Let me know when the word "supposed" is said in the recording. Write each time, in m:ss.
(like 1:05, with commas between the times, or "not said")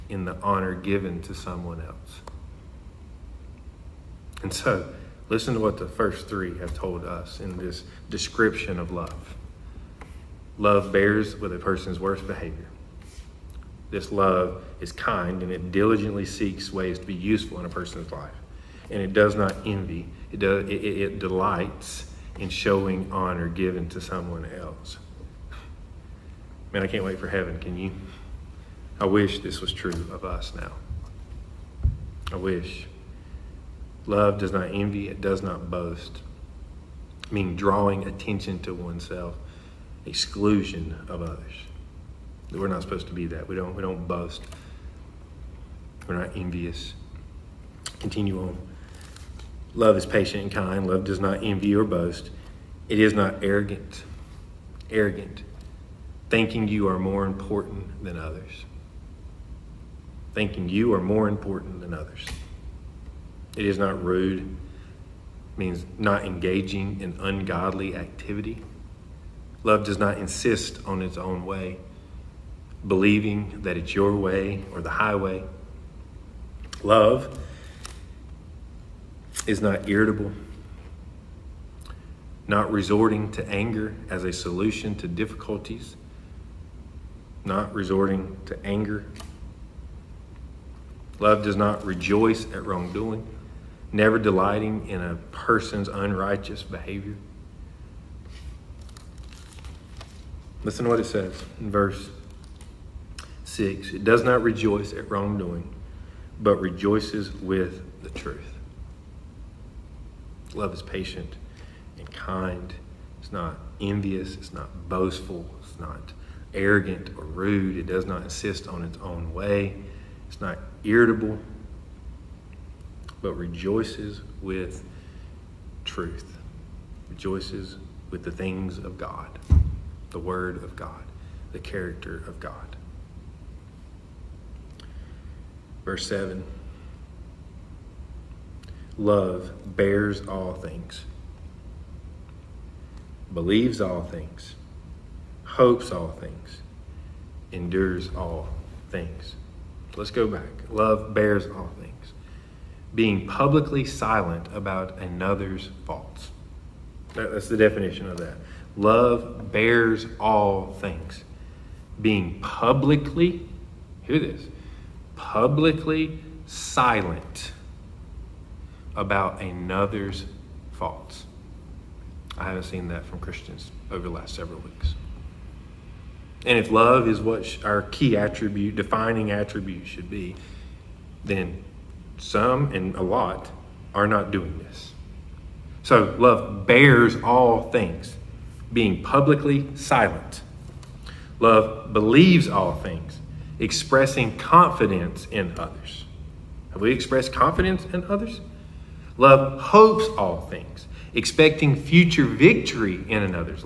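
0:42.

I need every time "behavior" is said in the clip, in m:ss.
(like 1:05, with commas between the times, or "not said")
0:12, 1:36.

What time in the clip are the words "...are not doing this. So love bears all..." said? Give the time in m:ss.
3:03.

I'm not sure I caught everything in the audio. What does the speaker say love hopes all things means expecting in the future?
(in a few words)
Future victory.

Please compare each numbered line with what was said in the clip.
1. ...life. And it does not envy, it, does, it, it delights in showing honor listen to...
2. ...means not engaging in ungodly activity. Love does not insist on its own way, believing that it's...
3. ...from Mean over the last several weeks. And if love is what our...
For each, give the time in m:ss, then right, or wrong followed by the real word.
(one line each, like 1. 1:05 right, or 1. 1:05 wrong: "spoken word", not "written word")
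1. 0:18 wrong: "given", not "listen"
2. 1:05 right
3. 2:53 wrong: "Christians", not "Mean".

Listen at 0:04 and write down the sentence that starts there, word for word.
And so, listen to what the first three have told us in this description of love.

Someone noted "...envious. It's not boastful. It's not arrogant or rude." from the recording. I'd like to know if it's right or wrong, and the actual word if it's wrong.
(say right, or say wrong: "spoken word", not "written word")
right.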